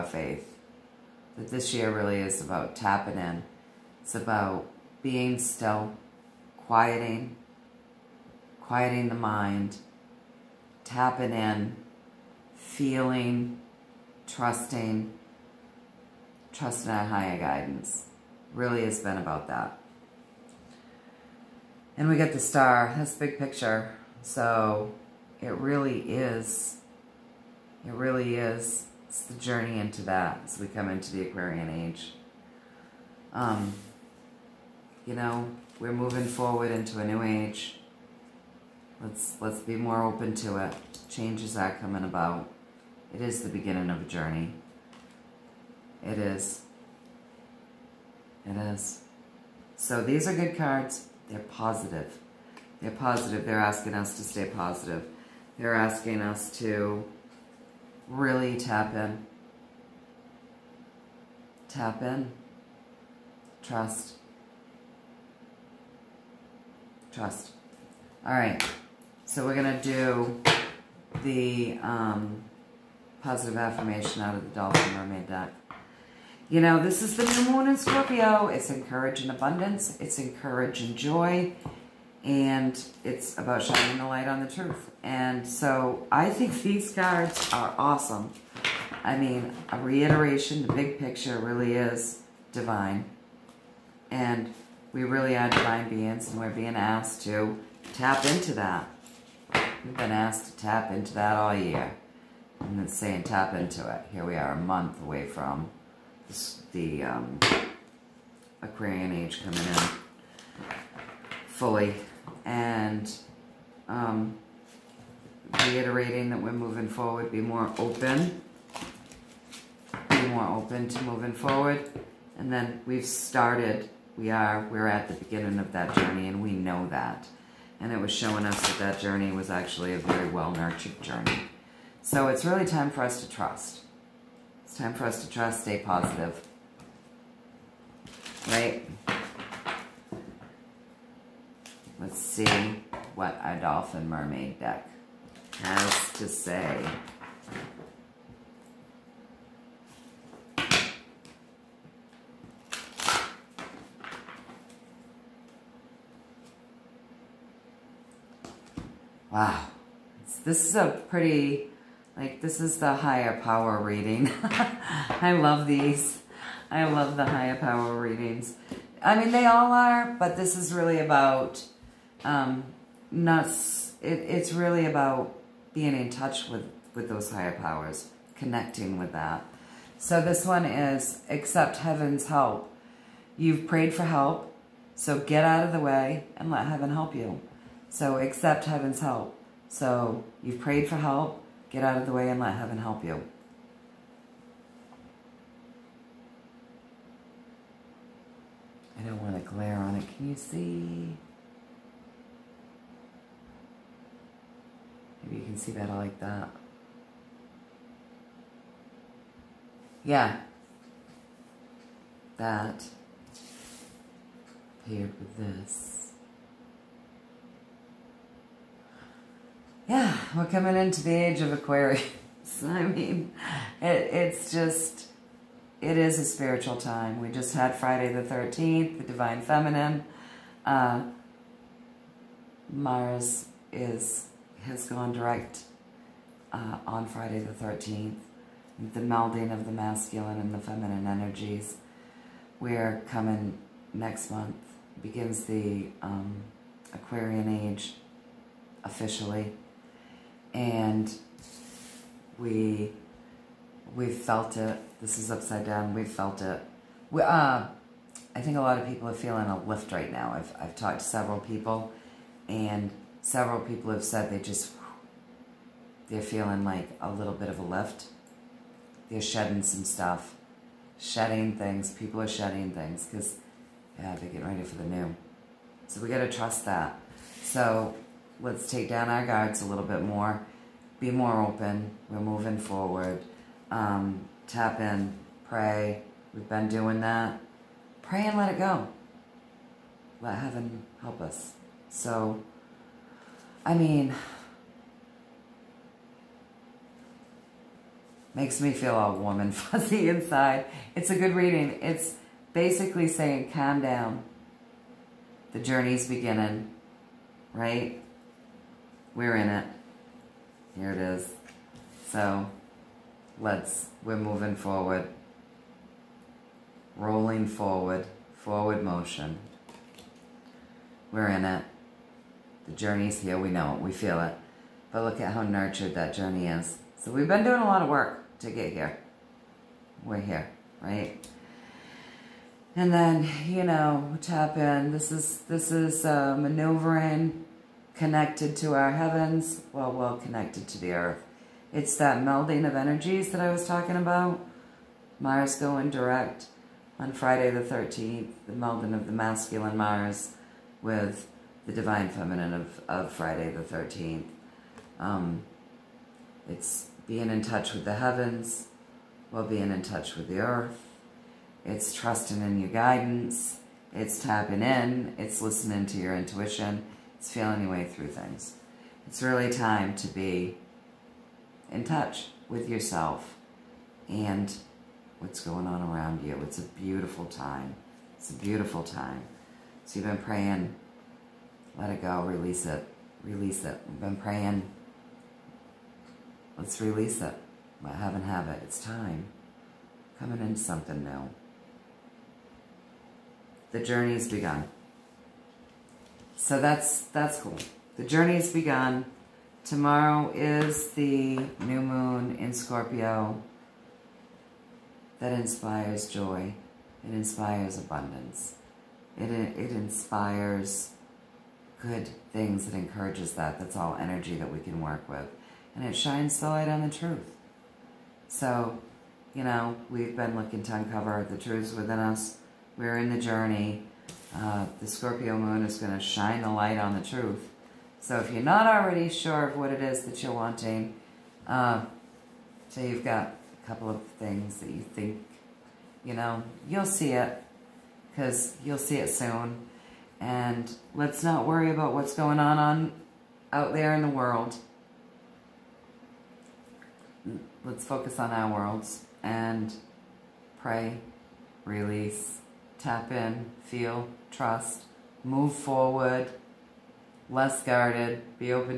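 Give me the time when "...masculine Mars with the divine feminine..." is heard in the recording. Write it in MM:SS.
05:49.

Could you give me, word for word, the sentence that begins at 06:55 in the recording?
And it shines the light on the truth.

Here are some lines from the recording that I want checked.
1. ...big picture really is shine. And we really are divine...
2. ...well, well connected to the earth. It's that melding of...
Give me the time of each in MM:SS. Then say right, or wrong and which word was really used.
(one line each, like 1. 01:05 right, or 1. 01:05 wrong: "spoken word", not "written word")
1. 01:30 wrong: "divine", not "shine"
2. 05:39 right.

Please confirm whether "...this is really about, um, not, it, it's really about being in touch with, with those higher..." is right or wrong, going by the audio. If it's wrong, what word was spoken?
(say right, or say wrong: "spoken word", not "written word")
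right.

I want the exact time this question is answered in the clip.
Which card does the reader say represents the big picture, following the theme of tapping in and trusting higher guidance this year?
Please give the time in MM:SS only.
00:22.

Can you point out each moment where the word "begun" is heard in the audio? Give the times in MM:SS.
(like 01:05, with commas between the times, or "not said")
06:34, 06:38.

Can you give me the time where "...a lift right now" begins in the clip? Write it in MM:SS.
04:19.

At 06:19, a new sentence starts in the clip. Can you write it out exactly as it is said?
So you've been praying, let it go, release it, release it.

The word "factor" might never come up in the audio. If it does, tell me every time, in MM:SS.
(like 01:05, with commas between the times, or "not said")
not said.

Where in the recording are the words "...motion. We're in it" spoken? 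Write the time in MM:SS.
05:18.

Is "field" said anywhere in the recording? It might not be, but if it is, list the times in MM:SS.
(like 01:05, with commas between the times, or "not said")
not said.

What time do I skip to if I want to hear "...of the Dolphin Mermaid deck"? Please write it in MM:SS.
01:14.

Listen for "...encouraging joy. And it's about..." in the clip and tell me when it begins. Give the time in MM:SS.
01:20.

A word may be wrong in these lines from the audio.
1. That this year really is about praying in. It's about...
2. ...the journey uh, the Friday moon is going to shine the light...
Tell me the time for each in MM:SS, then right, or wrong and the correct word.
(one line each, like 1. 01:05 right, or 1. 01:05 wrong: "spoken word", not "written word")
1. 00:01 wrong: "tapping", not "praying"
2. 07:03 wrong: "Scorpio", not "Friday".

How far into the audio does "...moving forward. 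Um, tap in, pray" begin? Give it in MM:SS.
04:42.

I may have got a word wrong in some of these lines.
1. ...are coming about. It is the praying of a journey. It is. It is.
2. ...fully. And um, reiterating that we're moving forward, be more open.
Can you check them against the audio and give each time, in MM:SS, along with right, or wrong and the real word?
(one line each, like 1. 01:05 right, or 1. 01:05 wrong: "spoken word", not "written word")
1. 00:41 wrong: "beginning", not "praying"
2. 01:51 right.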